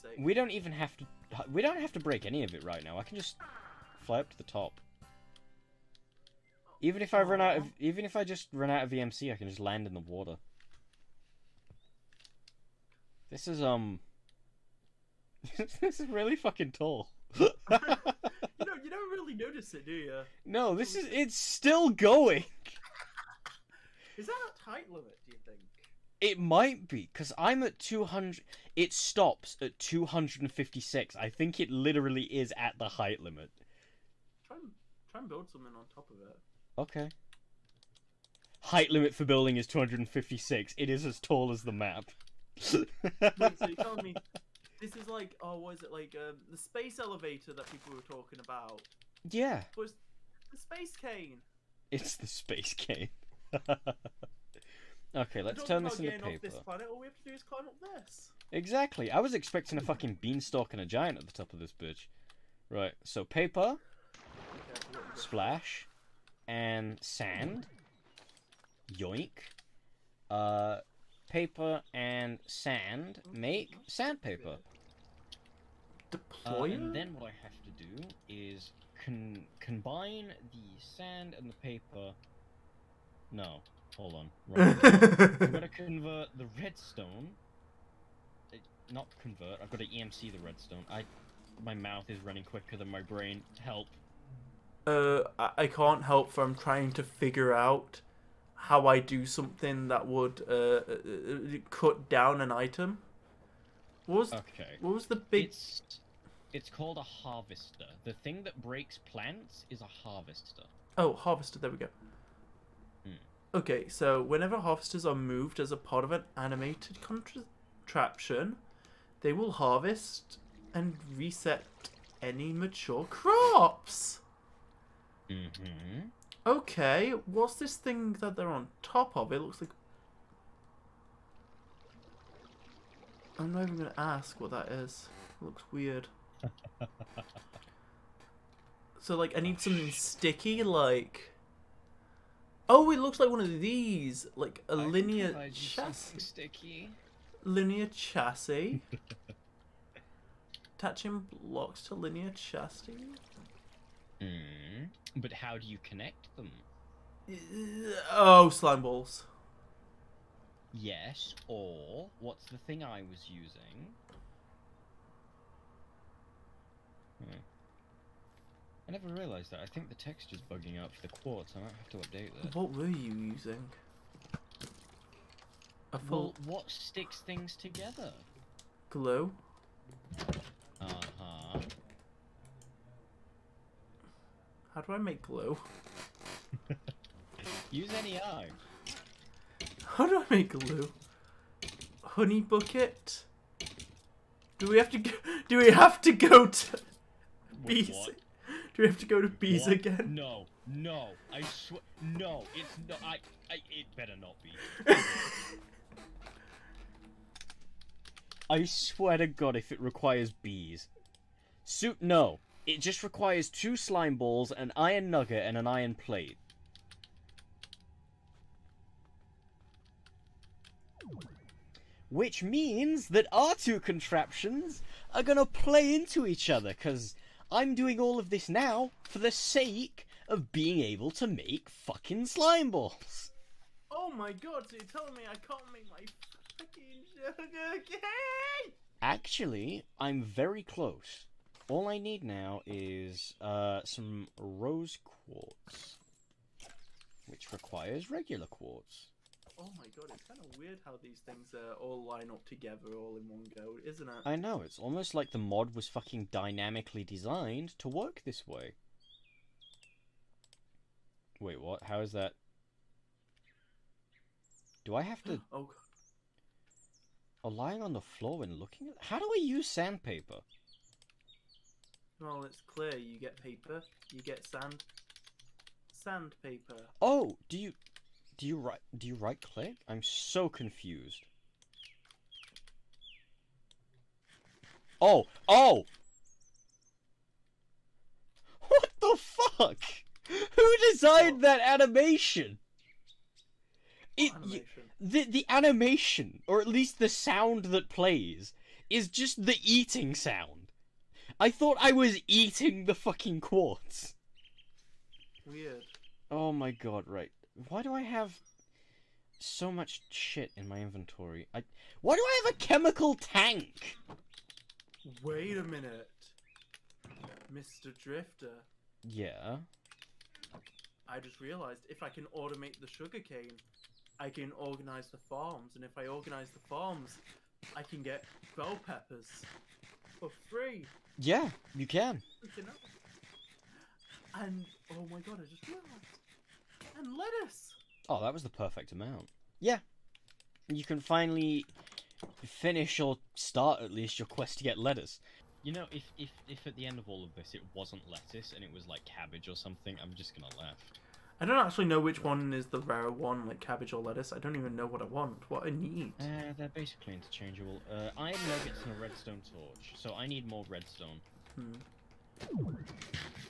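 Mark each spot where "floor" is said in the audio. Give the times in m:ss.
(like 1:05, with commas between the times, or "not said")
4:28.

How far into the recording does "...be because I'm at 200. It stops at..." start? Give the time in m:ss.
0:26.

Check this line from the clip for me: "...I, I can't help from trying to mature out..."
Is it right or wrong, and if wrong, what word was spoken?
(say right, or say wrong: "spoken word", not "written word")
wrong: "figure", not "mature".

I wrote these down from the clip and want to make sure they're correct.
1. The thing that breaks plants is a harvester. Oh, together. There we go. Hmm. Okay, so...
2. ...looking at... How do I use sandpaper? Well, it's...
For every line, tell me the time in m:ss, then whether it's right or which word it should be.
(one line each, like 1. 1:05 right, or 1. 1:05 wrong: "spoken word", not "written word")
1. 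1:48 wrong: "harvester", not "together"
2. 4:28 right.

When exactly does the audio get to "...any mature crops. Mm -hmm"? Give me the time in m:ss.
2:02.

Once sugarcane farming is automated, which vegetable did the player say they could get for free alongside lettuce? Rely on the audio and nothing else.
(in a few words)
bell peppers.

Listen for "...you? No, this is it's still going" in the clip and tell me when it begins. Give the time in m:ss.
0:19.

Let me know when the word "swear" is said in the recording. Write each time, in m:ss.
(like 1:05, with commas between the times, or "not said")
3:21, 3:28.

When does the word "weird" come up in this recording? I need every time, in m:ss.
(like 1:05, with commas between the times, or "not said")
2:15, 4:10, 5:05.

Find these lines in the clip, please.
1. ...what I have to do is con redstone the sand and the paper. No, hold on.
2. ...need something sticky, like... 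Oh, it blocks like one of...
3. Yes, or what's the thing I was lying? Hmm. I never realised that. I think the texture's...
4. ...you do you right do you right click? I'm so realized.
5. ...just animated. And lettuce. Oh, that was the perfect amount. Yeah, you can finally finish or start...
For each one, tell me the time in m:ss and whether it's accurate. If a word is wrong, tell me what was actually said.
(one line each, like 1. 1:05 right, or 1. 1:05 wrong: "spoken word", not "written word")
1. 1:17 wrong: "combine", not "redstone"
2. 2:19 wrong: "looks", not "blocks"
3. 2:40 wrong: "using", not "lying"
4. 4:37 wrong: "confused", not "realized"
5. 5:35 wrong: "realized", not "animated".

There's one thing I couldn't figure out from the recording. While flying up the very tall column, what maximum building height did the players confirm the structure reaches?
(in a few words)
256.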